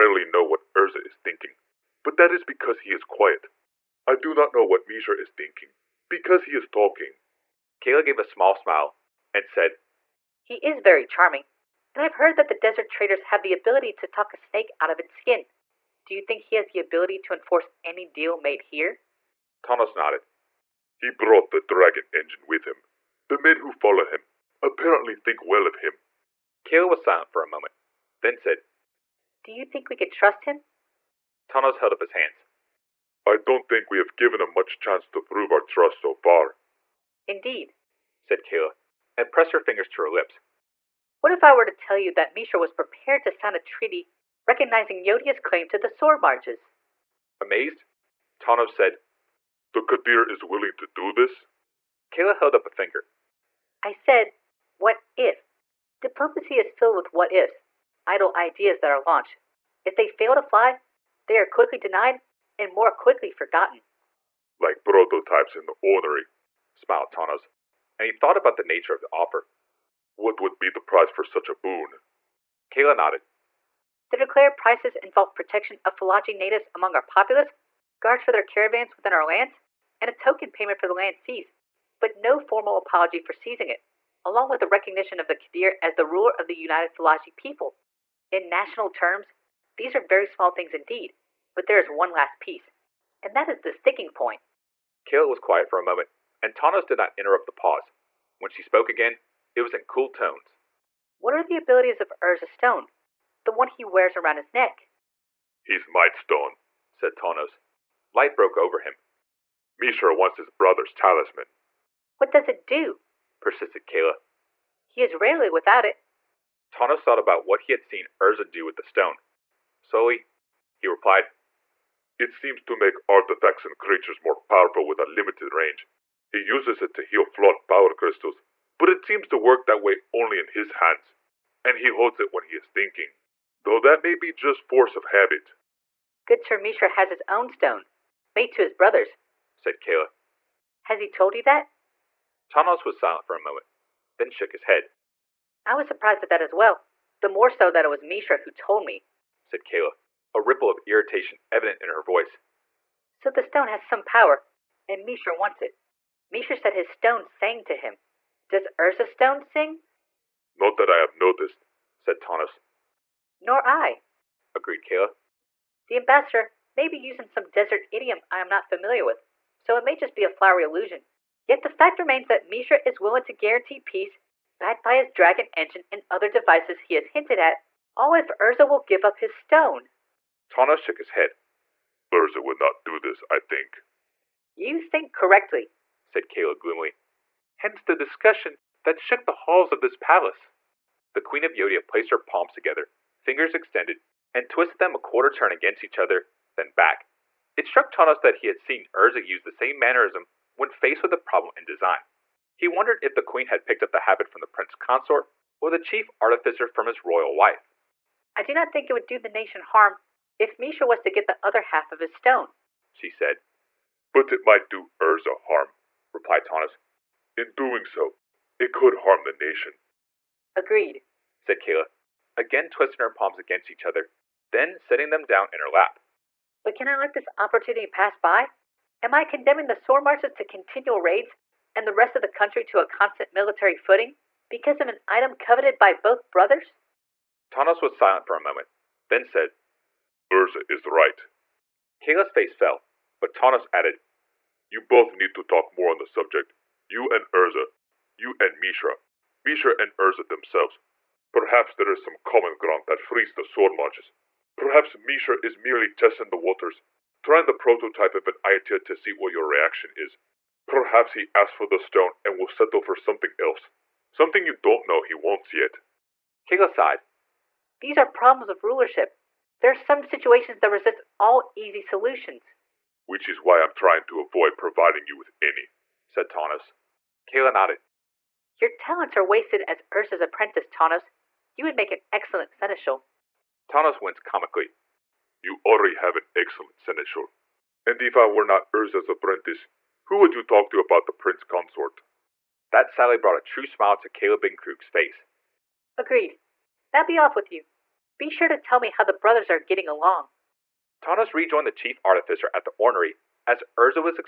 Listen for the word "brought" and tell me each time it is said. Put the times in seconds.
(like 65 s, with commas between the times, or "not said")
21 s, 293 s.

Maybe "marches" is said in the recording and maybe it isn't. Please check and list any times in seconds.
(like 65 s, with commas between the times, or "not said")
46 s, 230 s, 253 s.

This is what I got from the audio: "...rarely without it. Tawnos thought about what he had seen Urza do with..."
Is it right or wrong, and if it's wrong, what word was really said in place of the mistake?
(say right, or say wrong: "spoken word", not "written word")
right.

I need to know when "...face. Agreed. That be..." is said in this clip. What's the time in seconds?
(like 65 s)
294 s.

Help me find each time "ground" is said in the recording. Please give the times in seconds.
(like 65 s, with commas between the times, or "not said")
252 s.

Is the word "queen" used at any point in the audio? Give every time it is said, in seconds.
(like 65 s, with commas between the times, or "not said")
191 s, 203 s.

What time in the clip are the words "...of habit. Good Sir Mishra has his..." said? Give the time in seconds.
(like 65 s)
134 s.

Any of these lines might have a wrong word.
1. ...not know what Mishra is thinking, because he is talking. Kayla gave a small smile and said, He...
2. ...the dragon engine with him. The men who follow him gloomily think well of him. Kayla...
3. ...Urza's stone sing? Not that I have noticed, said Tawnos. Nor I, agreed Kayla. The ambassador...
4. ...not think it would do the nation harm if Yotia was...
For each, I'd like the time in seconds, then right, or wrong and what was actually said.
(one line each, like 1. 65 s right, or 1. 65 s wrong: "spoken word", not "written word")
1. 4 s right
2. 21 s wrong: "apparently", not "gloomily"
3. 158 s right
4. 208 s wrong: "Mishra", not "Yotia".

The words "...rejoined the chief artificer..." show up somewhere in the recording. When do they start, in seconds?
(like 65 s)
301 s.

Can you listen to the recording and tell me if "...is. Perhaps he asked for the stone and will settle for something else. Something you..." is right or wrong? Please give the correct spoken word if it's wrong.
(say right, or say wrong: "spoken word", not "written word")
right.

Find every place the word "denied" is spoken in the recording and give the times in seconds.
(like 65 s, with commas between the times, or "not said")
61 s.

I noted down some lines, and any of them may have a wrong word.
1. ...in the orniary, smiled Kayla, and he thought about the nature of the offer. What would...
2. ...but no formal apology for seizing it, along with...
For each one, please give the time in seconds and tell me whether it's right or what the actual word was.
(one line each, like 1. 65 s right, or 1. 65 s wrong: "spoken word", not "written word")
1. 65 s wrong: "Tawnos", not "Kayla"
2. 81 s right.